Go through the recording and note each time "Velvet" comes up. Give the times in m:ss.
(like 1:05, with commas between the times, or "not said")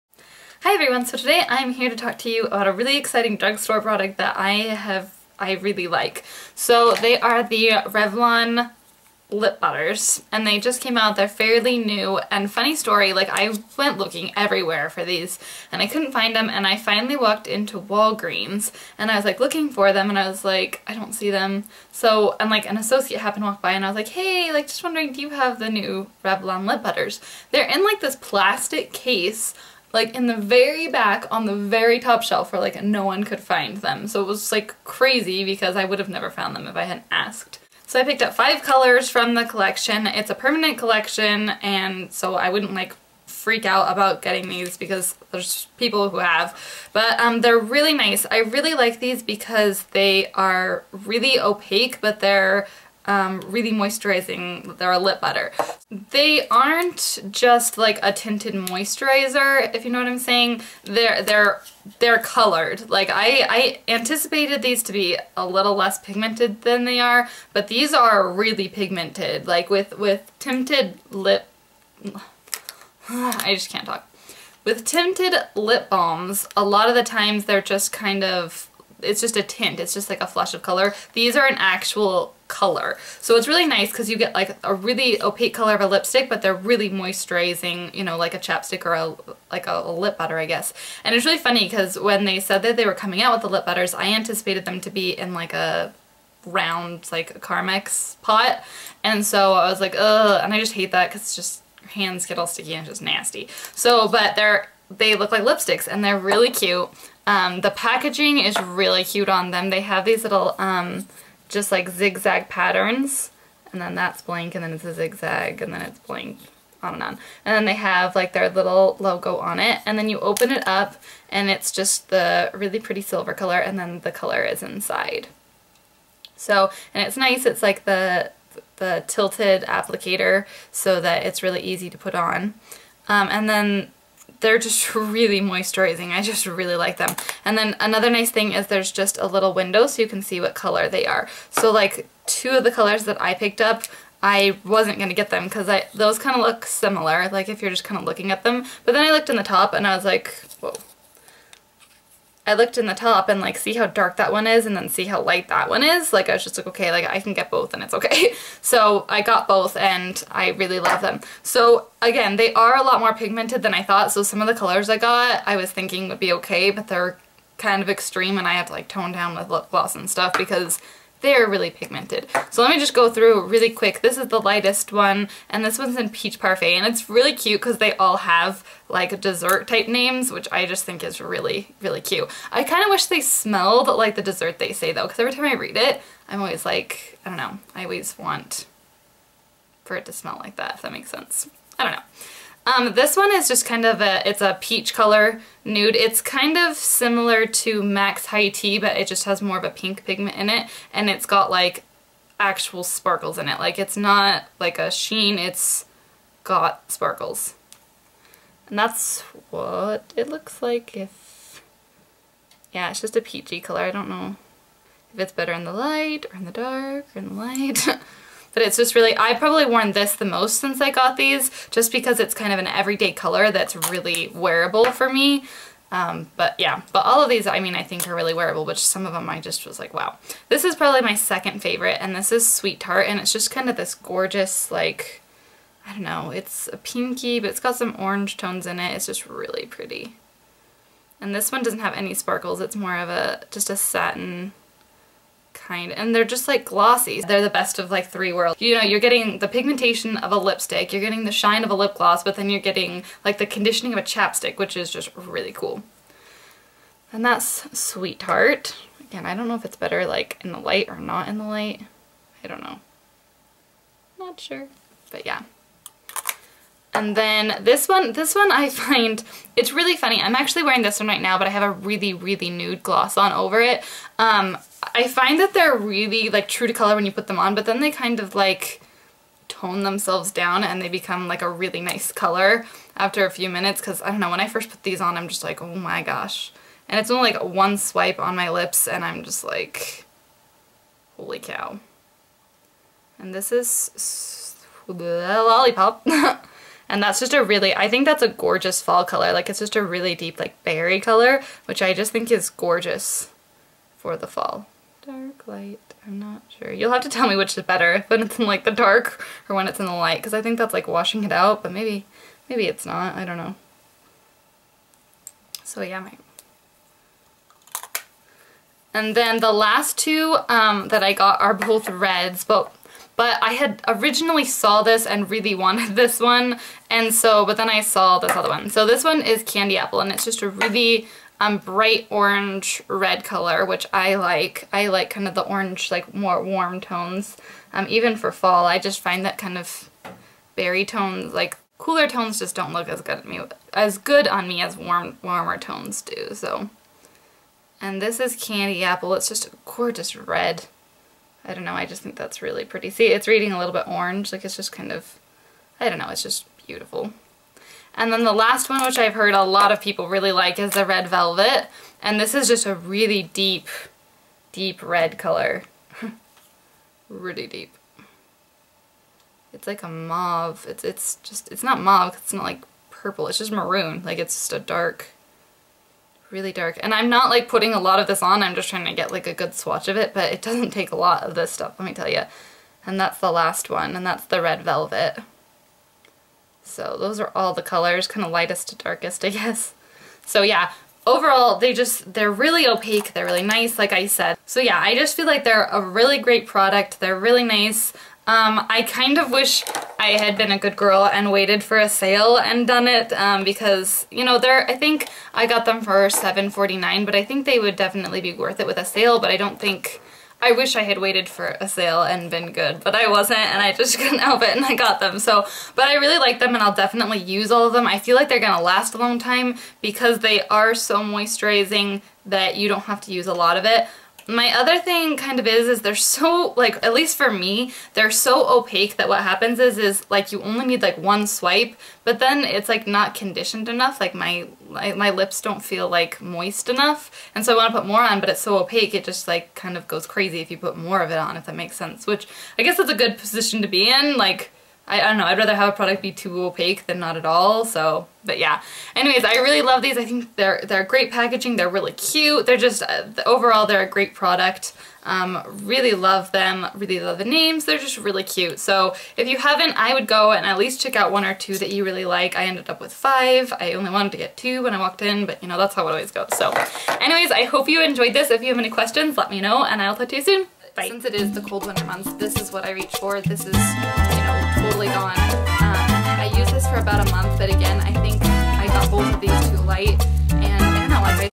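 6:01, 6:24.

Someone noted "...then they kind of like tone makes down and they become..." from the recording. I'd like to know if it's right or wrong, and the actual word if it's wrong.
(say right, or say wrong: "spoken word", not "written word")
wrong: "themselves", not "makes".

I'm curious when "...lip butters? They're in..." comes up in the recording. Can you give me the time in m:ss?
0:26.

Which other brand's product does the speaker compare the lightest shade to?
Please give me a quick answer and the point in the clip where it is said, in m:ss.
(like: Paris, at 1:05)
MAC High Tea, at 3:17.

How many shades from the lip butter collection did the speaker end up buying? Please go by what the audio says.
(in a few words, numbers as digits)
5.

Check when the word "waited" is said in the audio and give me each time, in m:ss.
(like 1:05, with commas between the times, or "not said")
6:41, 6:50.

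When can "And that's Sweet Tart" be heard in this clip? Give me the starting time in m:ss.
4:17.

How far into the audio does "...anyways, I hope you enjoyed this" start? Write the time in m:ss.
7:46.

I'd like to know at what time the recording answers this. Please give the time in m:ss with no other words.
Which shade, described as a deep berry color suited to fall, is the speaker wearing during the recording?
4:54.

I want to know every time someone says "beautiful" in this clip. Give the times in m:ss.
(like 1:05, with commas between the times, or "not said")
5:56.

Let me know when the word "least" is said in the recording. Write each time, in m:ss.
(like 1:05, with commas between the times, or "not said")
7:06, 7:40.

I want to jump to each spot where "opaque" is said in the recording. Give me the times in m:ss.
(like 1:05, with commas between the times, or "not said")
0:51, 1:25, 6:32, 7:08, 7:18, 7:26.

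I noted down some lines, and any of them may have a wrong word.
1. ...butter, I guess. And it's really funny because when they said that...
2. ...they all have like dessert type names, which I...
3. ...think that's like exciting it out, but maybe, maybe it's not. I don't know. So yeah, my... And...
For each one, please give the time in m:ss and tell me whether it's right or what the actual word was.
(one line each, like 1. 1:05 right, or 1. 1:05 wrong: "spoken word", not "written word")
1. 1:30 right
2. 2:57 right
3. 5:10 wrong: "washing", not "exciting".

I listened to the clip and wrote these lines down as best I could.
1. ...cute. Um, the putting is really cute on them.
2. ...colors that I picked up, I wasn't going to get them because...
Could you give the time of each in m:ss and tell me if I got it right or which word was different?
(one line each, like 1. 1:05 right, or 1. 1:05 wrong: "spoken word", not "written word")
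1. 1:46 wrong: "packaging", not "putting"
2. 2:22 right.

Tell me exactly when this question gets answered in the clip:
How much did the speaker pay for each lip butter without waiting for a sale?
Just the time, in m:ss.
6:46.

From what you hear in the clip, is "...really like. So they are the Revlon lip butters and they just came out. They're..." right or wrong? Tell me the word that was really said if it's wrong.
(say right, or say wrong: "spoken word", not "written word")
right.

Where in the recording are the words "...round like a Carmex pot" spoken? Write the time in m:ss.
1:36.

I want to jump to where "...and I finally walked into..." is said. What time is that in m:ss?
0:16.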